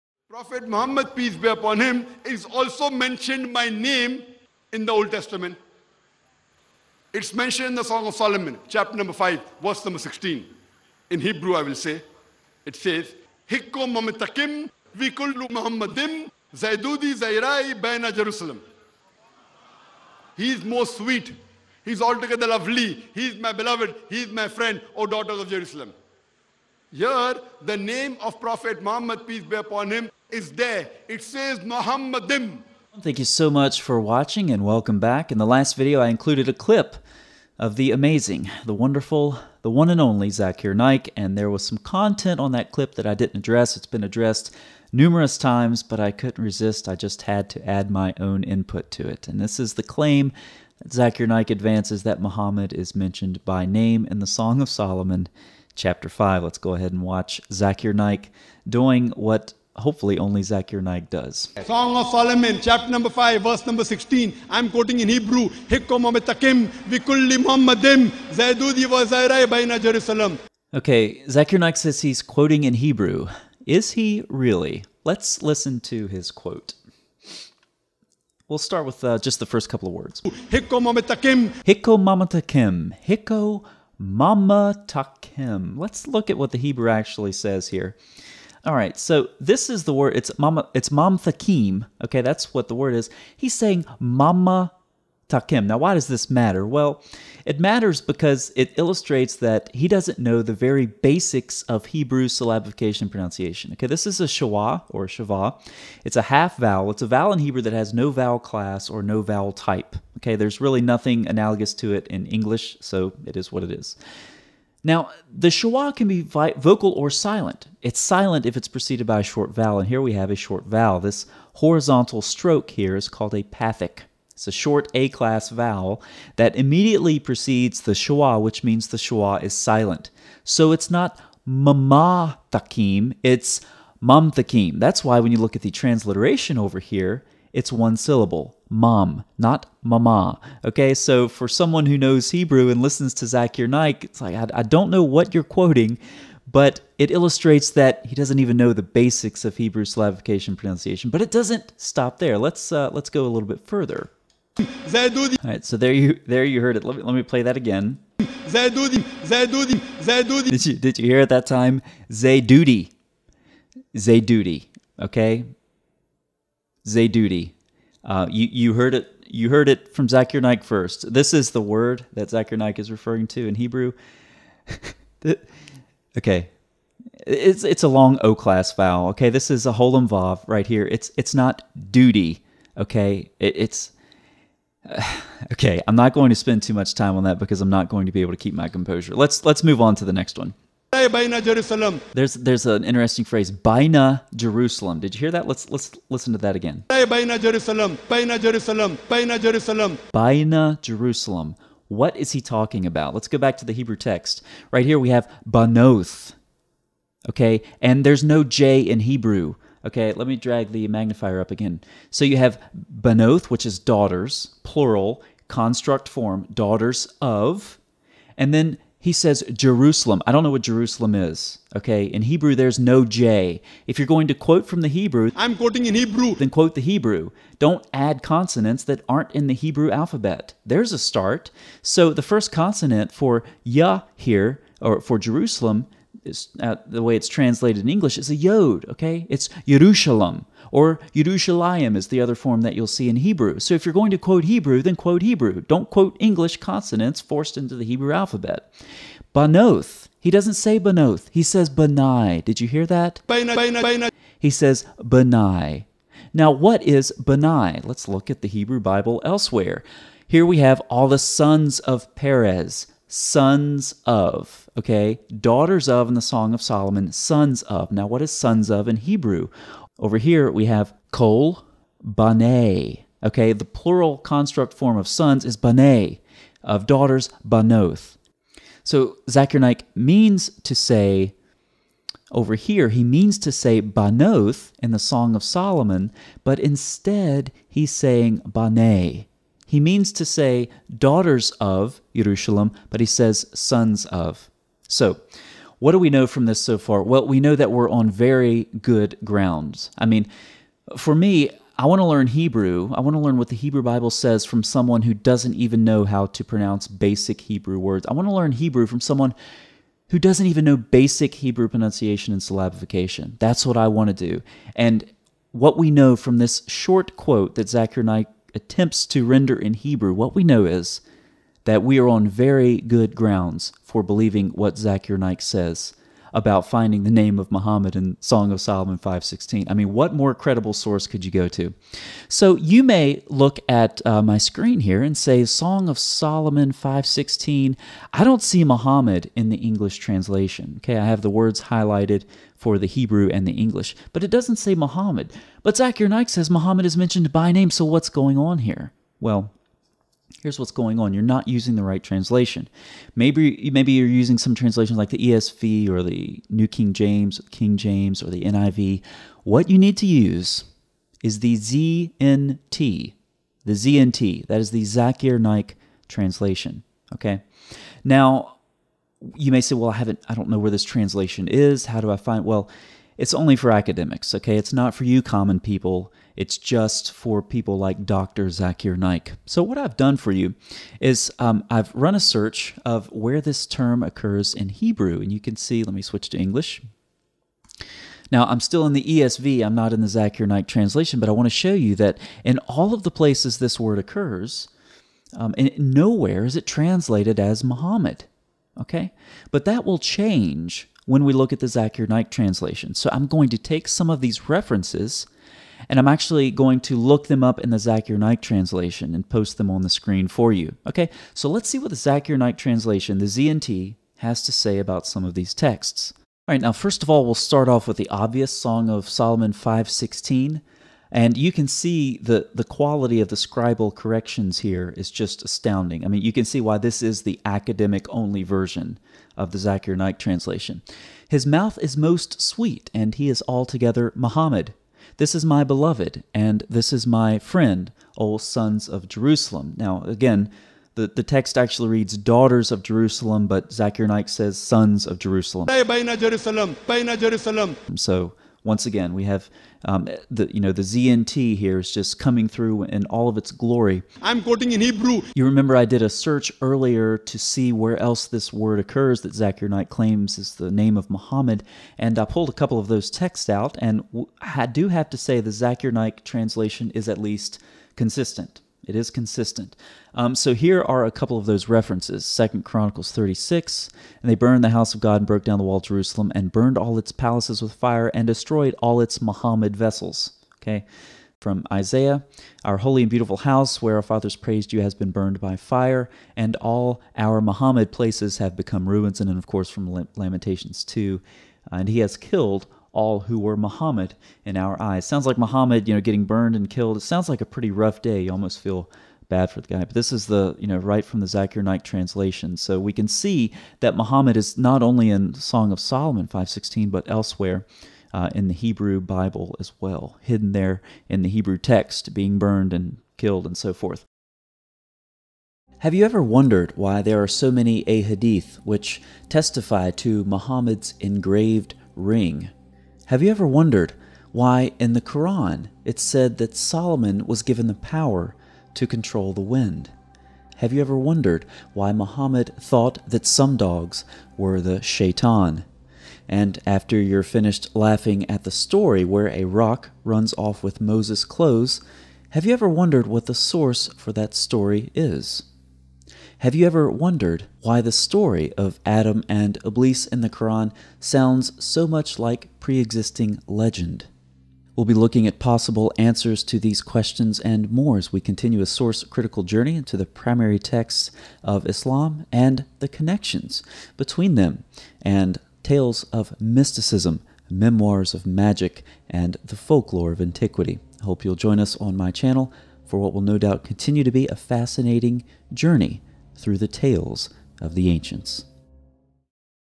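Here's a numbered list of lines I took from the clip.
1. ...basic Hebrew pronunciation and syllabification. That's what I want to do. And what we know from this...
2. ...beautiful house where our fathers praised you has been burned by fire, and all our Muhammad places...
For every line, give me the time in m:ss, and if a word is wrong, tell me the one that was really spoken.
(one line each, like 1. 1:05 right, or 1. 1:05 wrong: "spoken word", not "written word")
1. 5:10 right
2. 8:03 right.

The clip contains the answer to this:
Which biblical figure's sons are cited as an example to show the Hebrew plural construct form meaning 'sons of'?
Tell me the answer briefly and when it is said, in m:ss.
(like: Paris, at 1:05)
Perez, at 4:22.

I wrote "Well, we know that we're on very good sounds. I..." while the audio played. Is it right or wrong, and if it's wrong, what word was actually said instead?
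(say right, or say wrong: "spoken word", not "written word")
wrong: "grounds", not "sounds".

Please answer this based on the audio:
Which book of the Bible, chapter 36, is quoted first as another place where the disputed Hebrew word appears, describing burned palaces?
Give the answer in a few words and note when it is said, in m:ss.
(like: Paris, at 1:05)
Second Chronicles, at 7:52.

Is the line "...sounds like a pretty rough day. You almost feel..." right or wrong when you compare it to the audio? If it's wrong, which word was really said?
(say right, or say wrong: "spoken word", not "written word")
right.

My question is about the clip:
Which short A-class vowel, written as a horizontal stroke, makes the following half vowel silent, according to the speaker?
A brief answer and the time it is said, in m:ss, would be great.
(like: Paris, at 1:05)
pathic, at 2:03.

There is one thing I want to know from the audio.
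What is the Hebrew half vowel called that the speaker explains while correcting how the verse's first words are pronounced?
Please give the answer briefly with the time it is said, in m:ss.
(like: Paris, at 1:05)
shwa, at 1:44.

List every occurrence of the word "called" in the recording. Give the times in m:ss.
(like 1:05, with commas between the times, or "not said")
2:03.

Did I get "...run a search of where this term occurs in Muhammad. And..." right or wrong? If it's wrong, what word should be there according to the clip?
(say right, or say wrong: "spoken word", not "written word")
wrong: "Hebrew", not "Muhammad".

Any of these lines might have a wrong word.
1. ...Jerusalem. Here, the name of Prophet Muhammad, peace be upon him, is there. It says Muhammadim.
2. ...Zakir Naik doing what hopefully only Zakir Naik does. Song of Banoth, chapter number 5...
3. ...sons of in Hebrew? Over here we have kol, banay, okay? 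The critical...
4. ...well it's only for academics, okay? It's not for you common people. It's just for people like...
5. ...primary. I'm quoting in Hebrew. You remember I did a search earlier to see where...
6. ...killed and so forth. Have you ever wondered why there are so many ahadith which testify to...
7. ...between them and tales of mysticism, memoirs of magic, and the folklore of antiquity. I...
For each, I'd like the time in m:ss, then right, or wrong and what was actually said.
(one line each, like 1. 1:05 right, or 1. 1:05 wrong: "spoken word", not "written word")
1. 0:25 right
2. 0:57 wrong: "Solomon", not "Banoth"
3. 4:28 wrong: "plural", not "critical"
4. 6:12 right
5. 7:33 wrong: "glory", not "primary"
6. 8:33 right
7. 9:23 right.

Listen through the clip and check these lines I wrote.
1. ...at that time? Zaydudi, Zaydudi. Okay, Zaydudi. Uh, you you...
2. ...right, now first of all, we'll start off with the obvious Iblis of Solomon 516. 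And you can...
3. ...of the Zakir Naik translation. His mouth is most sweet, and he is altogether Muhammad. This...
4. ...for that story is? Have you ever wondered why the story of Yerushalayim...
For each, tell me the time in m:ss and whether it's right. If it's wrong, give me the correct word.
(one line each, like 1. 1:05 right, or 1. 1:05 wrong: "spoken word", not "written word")
1. 2:41 right
2. 6:56 wrong: "Song", not "Iblis"
3. 7:09 right
4. 9:03 wrong: "Adam", not "Yerushalayim".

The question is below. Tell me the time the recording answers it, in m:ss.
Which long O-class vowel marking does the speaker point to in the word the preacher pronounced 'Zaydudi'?
2:59.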